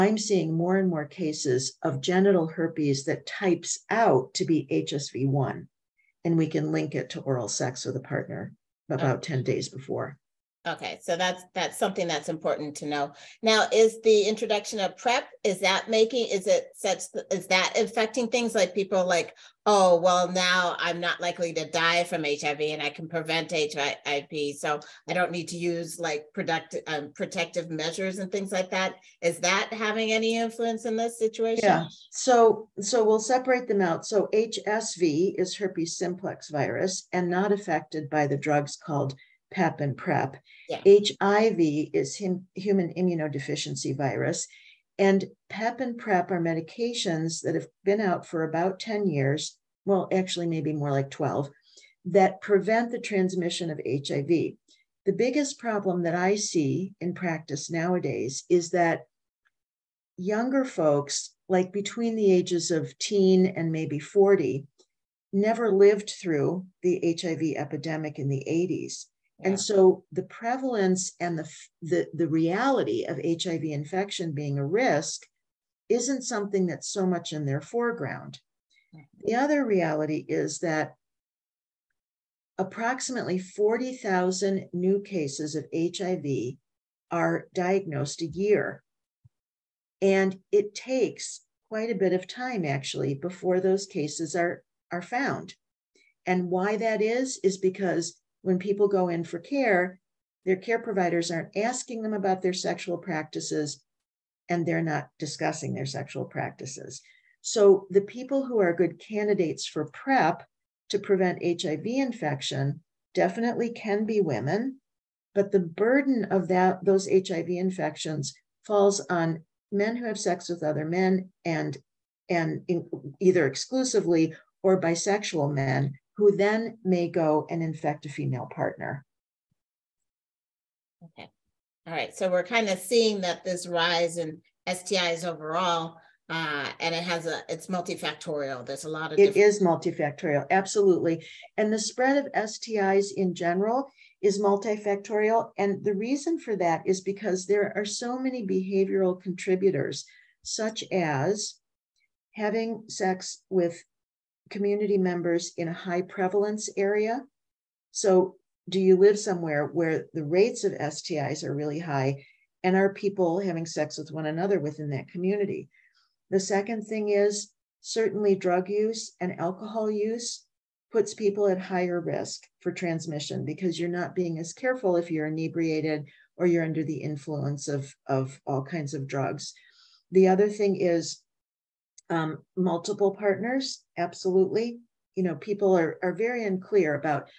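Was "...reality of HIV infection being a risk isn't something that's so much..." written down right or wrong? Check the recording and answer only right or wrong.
right.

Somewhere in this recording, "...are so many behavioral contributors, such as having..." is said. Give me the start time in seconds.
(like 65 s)
147 s.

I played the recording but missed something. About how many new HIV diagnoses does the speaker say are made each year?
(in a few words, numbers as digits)
40,000.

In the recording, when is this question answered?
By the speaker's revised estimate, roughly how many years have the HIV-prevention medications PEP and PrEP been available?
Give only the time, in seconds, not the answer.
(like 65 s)
51 s.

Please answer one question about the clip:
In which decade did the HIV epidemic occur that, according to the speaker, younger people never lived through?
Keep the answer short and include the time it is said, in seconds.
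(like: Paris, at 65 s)
the 80s, at 68 s.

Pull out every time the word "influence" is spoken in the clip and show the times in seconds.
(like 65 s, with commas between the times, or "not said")
30 s, 176 s.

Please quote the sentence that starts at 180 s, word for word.
The other thing is um, multiple partners, absolutely.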